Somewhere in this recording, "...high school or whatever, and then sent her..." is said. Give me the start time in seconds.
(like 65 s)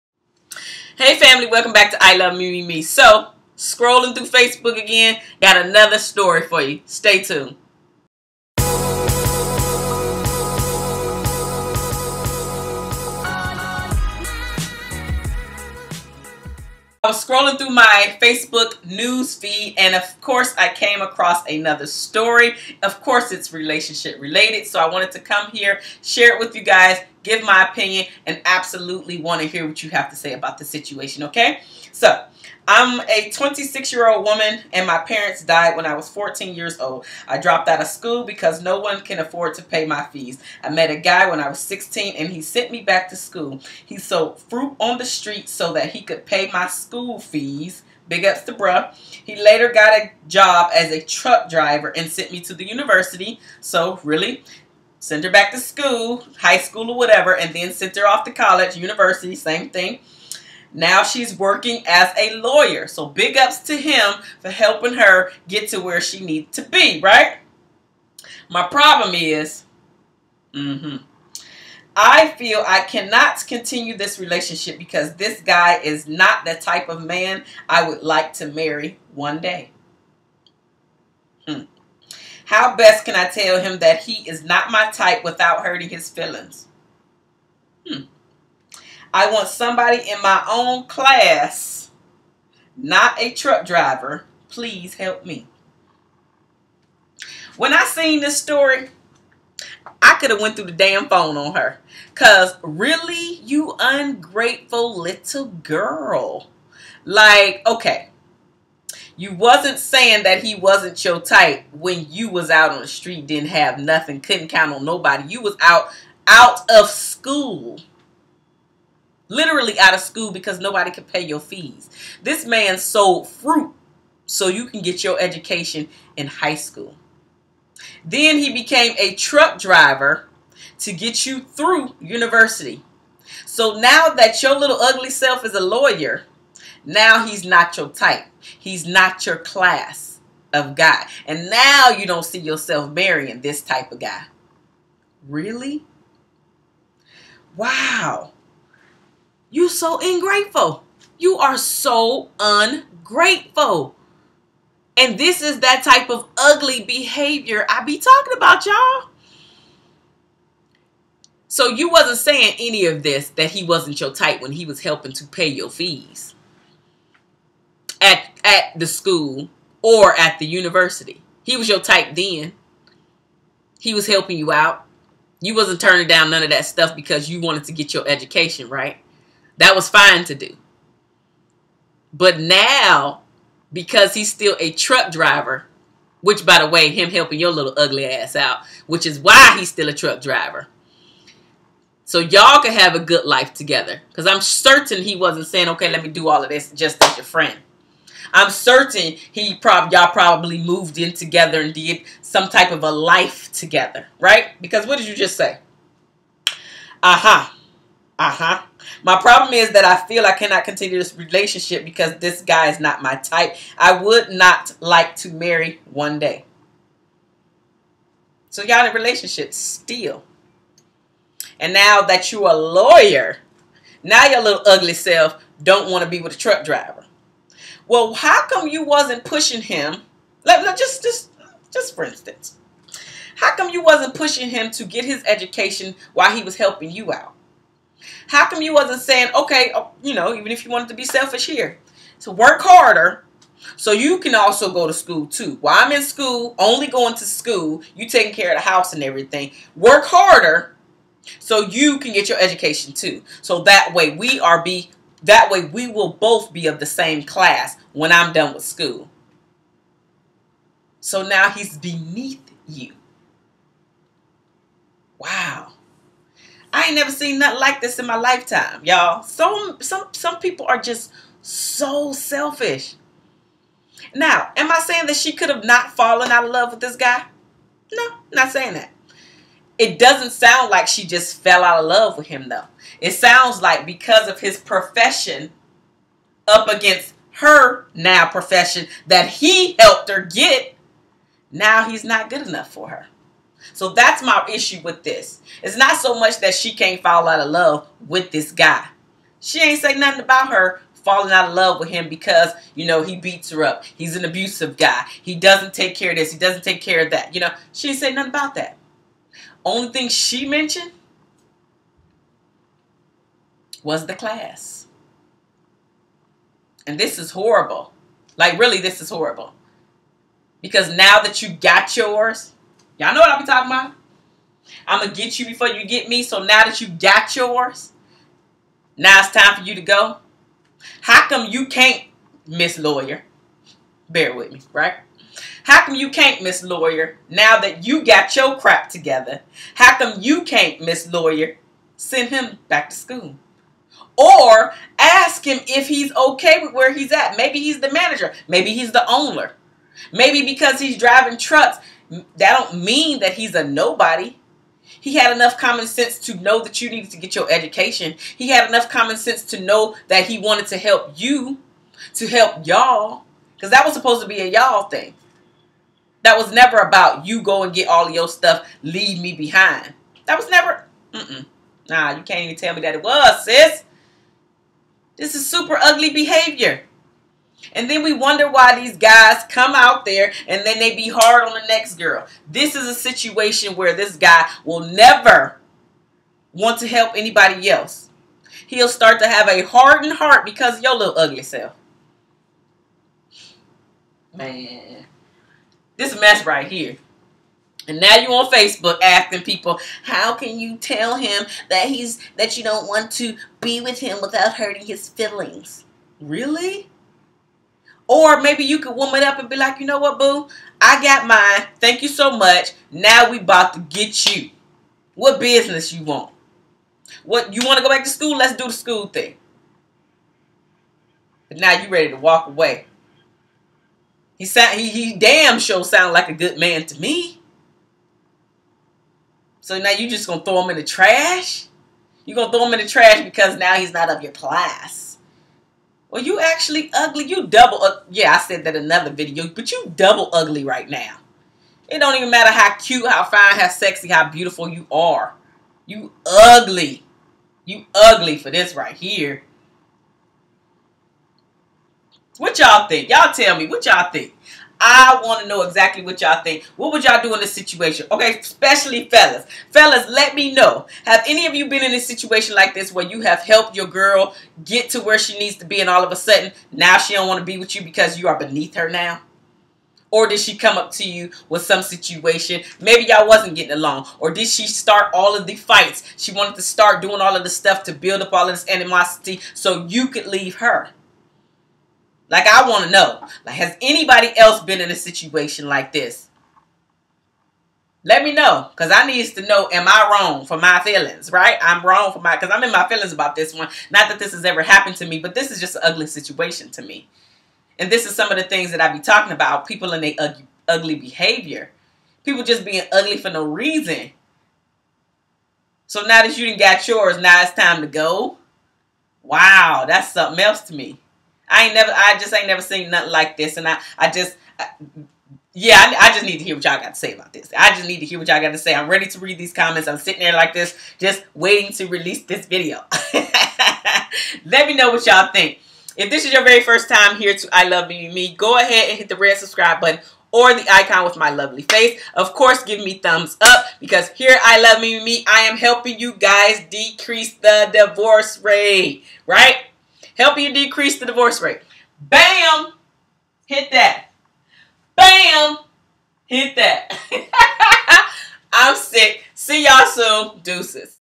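56 s.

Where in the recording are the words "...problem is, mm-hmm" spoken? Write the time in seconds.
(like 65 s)
68 s.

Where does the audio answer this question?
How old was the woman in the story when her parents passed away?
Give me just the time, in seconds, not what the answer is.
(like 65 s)
36 s.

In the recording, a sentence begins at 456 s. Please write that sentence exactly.
What would y'all do in this situation?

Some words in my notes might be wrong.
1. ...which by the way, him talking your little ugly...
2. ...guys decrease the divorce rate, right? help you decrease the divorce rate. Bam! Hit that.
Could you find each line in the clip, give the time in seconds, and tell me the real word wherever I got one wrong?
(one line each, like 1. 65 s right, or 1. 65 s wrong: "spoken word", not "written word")
1. 186 s wrong: "helping", not "talking"
2. 536 s right.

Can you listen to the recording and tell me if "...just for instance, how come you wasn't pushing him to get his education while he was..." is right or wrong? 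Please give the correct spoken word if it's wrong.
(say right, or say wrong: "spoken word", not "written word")
right.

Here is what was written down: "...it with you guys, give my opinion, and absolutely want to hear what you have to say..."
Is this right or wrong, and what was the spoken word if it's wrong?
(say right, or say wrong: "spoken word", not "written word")
right.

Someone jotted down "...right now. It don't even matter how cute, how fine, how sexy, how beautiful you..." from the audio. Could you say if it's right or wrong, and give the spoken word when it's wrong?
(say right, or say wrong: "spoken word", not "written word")
right.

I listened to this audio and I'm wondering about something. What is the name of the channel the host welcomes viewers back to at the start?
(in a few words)
I Love Me Me Me.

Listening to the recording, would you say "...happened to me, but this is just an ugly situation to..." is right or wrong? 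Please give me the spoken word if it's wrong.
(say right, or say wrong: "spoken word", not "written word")
right.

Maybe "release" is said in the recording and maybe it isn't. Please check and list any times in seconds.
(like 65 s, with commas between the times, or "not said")
521 s.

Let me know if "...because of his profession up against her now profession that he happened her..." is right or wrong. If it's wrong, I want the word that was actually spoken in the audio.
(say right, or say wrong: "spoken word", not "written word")
wrong: "helped", not "happened".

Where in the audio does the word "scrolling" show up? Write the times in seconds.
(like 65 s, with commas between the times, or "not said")
3 s, 17 s.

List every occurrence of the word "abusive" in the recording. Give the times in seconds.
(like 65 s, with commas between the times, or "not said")
304 s.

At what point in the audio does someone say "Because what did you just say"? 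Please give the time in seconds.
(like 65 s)
204 s.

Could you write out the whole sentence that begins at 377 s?
And then we wonder why these guys come out there and then they be hard on the next girl.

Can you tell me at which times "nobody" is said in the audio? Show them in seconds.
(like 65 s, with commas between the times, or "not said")
114 s, 120 s, 353 s.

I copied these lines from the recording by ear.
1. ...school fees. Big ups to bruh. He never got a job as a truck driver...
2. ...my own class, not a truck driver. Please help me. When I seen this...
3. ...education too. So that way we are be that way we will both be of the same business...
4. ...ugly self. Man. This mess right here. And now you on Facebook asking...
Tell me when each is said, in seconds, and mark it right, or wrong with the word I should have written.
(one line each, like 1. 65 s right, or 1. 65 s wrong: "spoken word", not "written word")
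1. 46 s wrong: "later", not "never"
2. 90 s right
3. 252 s wrong: "class", not "business"
4. 391 s right.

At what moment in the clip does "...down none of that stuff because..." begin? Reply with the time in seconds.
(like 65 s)
176 s.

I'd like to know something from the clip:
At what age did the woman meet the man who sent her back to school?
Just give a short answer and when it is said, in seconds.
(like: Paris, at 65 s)
16, at 41 s.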